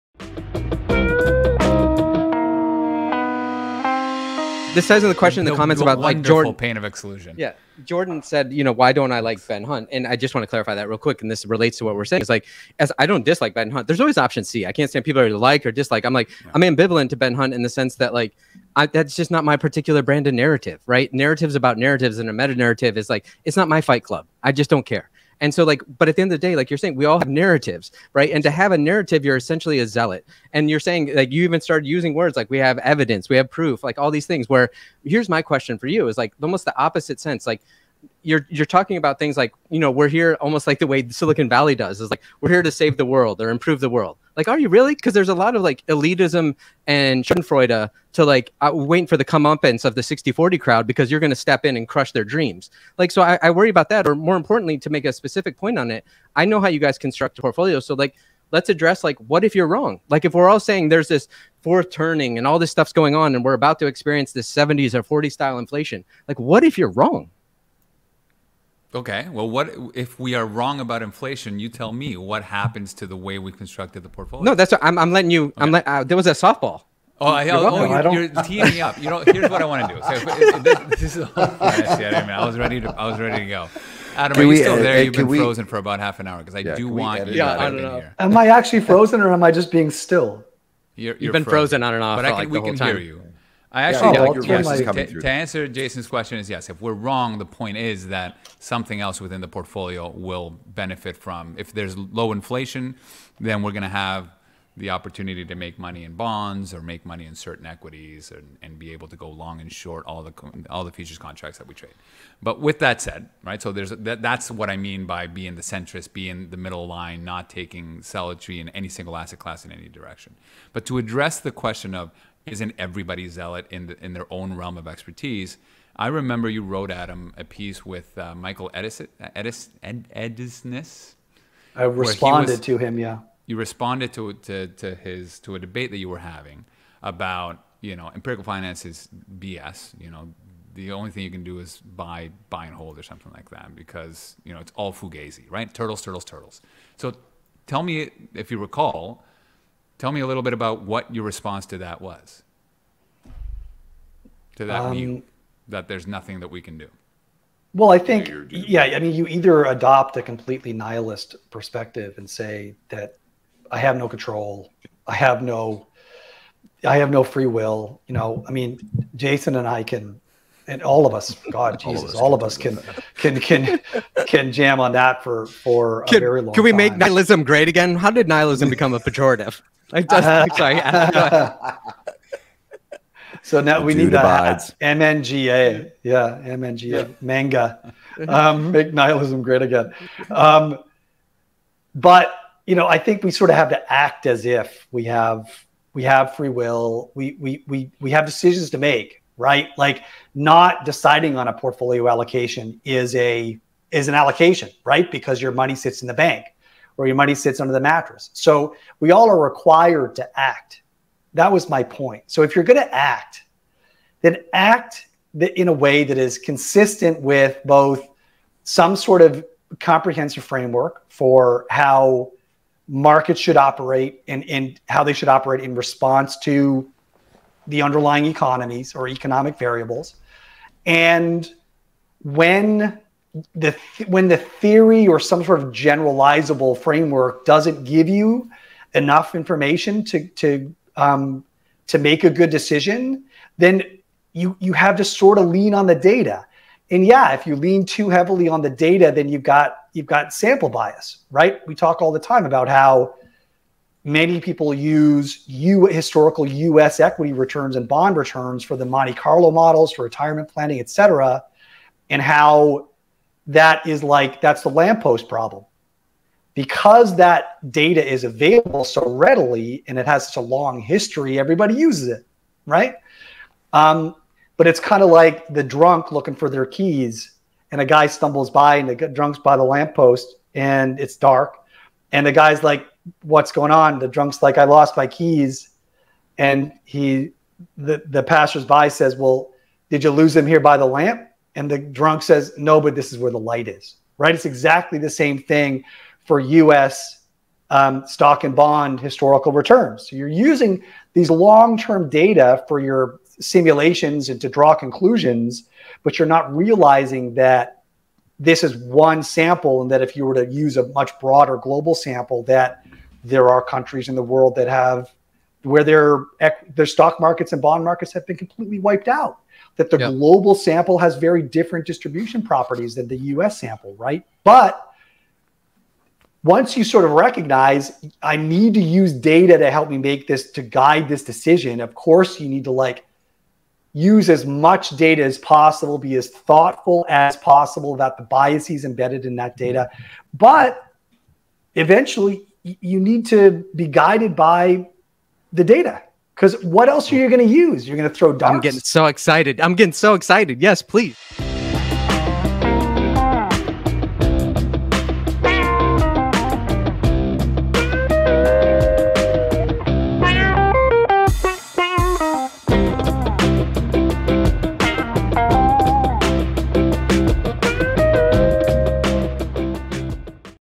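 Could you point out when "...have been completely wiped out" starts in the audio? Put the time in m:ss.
5:18.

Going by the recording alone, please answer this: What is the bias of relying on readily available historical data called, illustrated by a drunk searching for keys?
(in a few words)
lamppost problem.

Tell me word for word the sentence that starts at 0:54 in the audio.
Or more importantly, to make a specific point on it, I know how you guys construct a portfolio.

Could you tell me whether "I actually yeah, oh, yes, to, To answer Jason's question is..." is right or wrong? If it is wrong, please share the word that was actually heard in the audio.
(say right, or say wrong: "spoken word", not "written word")
right.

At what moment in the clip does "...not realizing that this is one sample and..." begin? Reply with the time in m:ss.
5:06.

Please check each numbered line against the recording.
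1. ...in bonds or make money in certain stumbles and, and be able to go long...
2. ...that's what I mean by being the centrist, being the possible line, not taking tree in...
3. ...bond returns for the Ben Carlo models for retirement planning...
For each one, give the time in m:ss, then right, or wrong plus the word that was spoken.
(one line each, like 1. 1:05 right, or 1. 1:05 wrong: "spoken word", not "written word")
1. 1:46 wrong: "equities", not "stumbles"
2. 1:54 wrong: "middle", not "possible"
3. 4:17 wrong: "Monte", not "Ben".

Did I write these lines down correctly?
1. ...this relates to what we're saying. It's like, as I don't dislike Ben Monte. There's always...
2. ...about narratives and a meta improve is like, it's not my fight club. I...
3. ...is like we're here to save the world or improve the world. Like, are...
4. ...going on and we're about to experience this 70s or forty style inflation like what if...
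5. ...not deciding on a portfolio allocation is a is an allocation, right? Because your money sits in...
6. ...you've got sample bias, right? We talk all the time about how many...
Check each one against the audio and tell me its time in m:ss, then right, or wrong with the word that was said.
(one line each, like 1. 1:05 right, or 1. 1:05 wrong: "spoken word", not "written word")
1. 0:11 wrong: "Hunt", not "Monte"
2. 0:21 wrong: "narrative", not "improve"
3. 0:42 right
4. 1:02 right
5. 3:20 right
6. 4:09 right.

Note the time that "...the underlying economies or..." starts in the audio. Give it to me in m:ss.
3:47.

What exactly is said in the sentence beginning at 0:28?
And to have a narrative, you're essentially a zealot.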